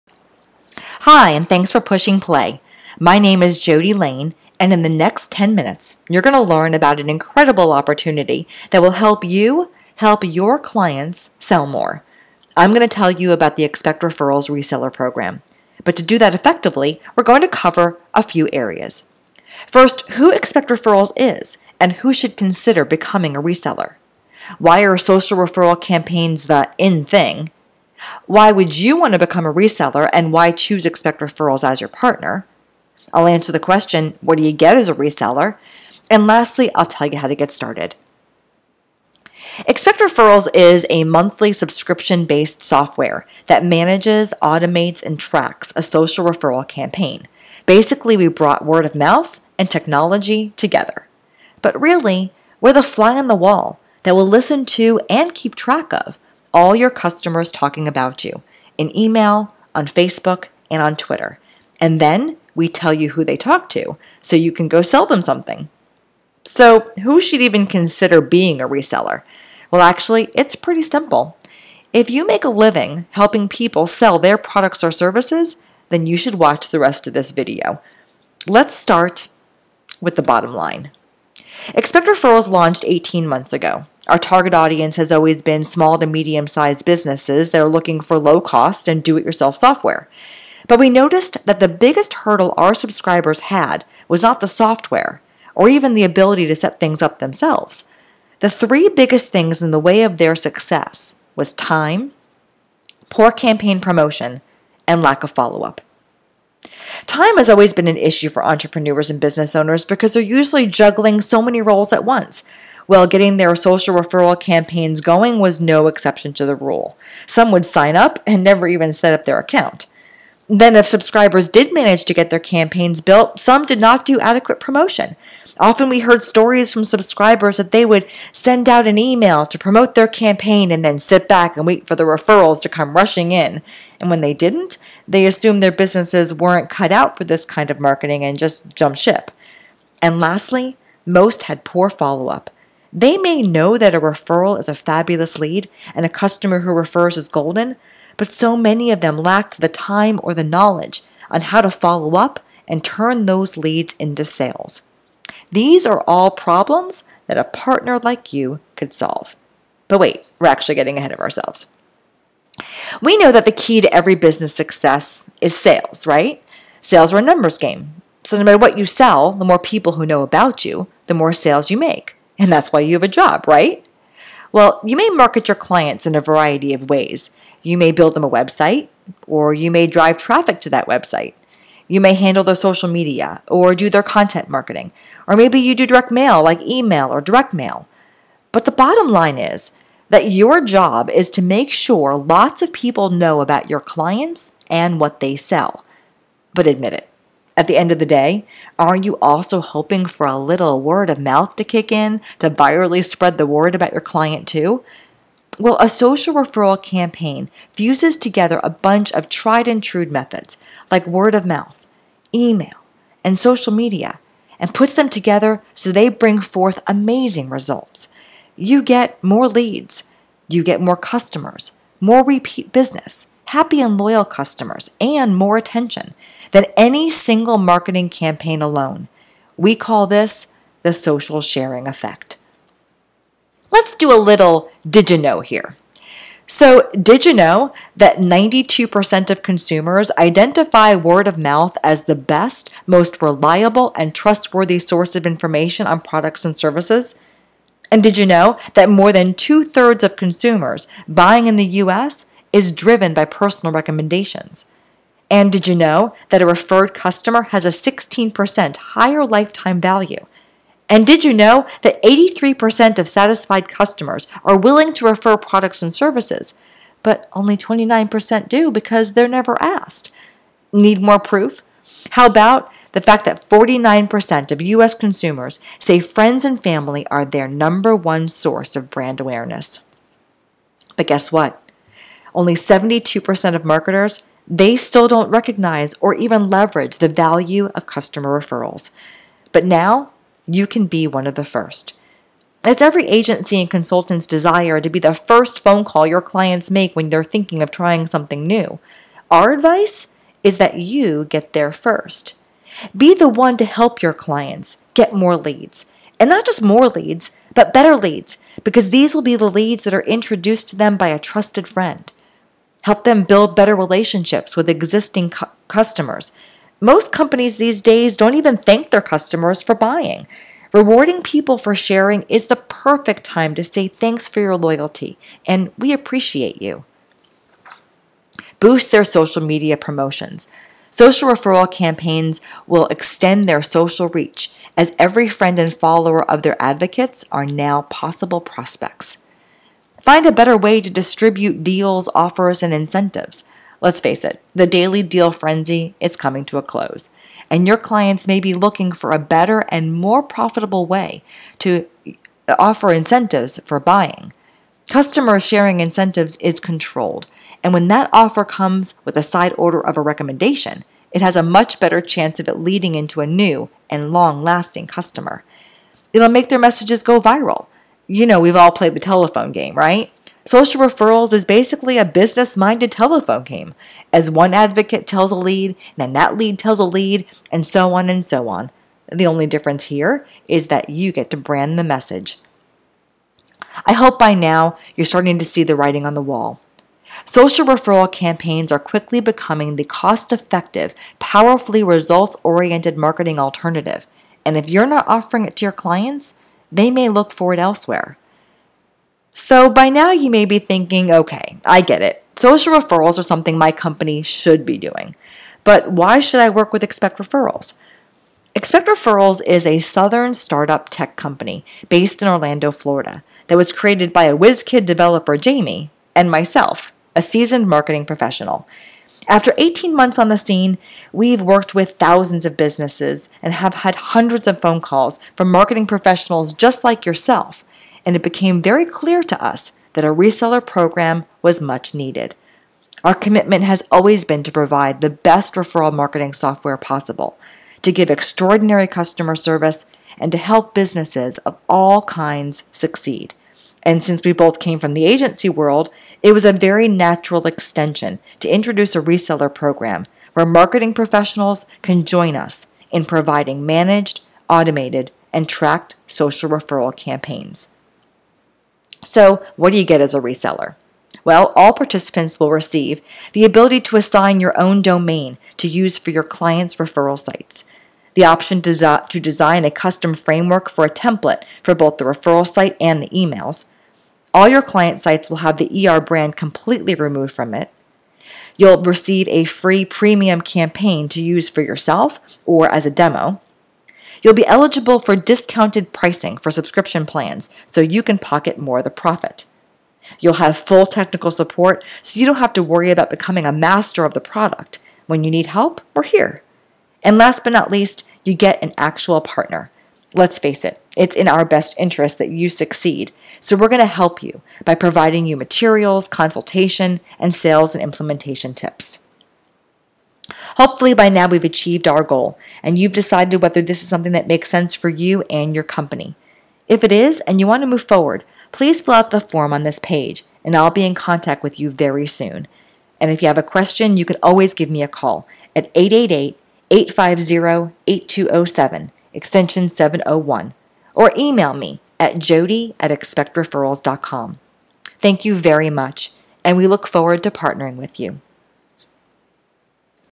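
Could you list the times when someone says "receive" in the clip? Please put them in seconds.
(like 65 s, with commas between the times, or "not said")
462 s, 478 s.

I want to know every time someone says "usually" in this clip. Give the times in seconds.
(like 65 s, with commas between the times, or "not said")
110 s.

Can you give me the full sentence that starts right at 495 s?
When you need help, we're here.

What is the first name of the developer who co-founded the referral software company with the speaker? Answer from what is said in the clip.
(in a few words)
Jamie.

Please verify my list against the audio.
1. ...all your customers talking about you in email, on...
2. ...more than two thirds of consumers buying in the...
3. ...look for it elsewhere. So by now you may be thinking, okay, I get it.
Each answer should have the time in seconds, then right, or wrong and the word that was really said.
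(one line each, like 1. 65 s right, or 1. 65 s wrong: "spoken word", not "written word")
1. 56 s right
2. 248 s right
3. 397 s right.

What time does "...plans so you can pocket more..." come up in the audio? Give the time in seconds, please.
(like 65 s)
487 s.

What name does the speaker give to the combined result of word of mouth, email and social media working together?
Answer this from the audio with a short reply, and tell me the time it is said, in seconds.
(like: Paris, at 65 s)
social sharing effect, at 230 s.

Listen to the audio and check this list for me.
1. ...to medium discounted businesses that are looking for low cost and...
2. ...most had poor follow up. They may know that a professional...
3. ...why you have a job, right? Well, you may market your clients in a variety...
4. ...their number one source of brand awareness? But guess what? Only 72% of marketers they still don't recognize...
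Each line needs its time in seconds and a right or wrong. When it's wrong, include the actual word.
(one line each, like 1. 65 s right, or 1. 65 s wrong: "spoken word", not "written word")
1. 85 s wrong: "sized", not "discounted"
2. 141 s wrong: "referral", not "professional"
3. 172 s right
4. 277 s right.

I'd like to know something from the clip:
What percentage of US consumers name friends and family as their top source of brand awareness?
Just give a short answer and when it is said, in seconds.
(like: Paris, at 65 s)
49%, at 273 s.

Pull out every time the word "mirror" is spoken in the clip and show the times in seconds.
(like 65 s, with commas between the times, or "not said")
not said.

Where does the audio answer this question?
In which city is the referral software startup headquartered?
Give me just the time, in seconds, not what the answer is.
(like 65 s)
412 s.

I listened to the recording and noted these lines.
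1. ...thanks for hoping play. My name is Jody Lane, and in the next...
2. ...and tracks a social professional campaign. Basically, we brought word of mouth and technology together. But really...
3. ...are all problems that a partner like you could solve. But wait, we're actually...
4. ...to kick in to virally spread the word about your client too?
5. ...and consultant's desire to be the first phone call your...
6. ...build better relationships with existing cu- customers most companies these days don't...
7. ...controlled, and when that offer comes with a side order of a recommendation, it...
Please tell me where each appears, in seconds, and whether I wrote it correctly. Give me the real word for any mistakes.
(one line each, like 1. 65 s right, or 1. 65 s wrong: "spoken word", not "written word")
1. 1 s wrong: "pushing", not "hoping"
2. 45 s wrong: "referral", not "professional"
3. 155 s right
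4. 201 s right
5. 293 s right
6. 313 s right
7. 356 s right.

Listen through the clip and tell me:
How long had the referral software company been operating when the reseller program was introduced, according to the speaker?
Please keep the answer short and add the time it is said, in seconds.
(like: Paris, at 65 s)
18 months, at 82 s.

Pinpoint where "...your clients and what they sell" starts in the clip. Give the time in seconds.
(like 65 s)
193 s.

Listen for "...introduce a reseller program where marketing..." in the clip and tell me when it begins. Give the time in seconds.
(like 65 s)
448 s.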